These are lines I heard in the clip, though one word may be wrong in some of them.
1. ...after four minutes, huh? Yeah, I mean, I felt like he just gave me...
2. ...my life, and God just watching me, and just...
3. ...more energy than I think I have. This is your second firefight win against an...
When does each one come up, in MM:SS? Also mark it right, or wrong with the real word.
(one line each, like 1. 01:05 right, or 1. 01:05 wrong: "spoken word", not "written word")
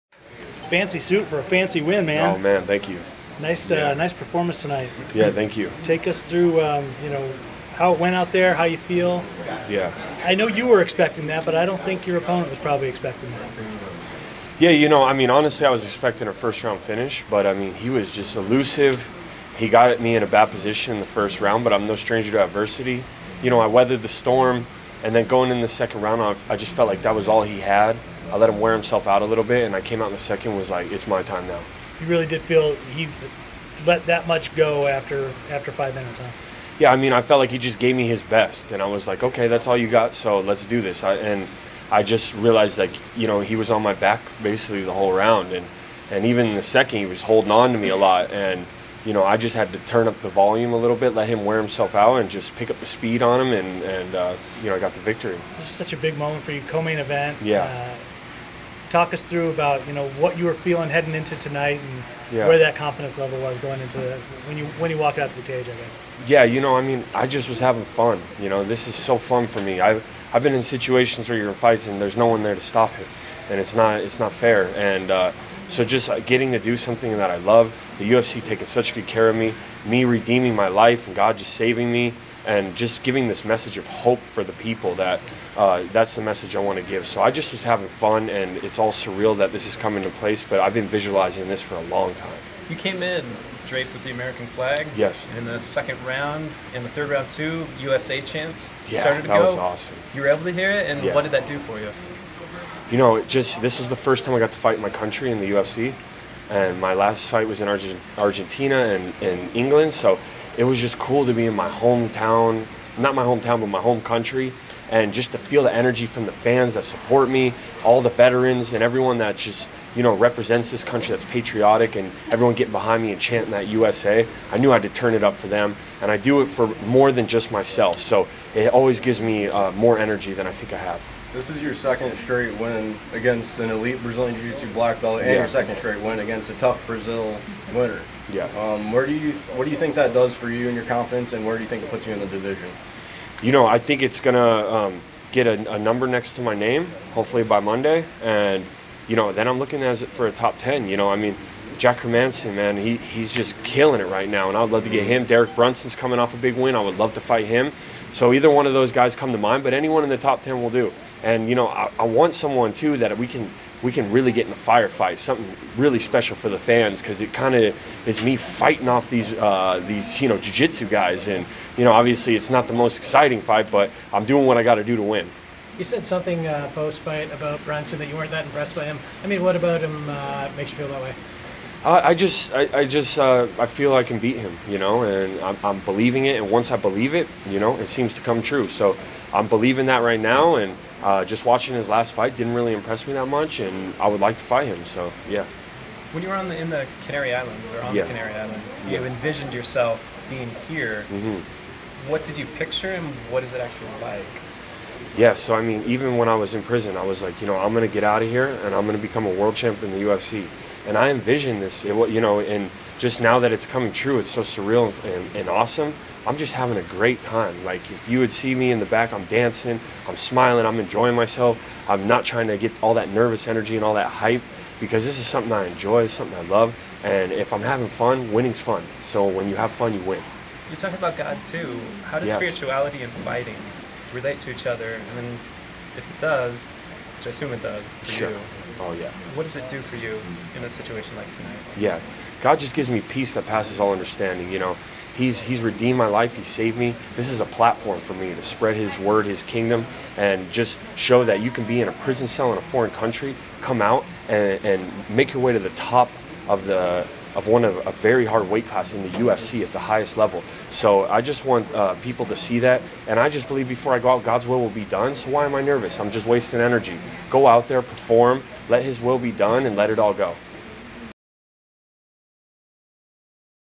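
1. 00:35 wrong: "five", not "four"
2. 01:20 wrong: "saving", not "watching"
3. 02:09 wrong: "straight", not "firefight".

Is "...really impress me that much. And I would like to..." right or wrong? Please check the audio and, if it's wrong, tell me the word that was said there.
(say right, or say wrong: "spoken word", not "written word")
right.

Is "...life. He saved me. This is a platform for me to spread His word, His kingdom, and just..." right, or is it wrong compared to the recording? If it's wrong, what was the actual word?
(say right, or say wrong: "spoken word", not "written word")
right.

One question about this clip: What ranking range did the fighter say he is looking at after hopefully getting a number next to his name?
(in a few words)
top 10.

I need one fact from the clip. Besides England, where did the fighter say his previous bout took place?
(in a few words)
Argentina.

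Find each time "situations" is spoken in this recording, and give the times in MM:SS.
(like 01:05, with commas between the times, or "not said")
01:10, 04:00.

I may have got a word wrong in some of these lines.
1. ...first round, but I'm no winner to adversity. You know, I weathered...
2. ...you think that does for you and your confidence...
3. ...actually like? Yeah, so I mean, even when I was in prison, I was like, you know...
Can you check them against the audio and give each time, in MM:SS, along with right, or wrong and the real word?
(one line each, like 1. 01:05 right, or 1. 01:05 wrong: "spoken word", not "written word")
1. 00:21 wrong: "stranger", not "winner"
2. 02:19 right
3. 03:23 right.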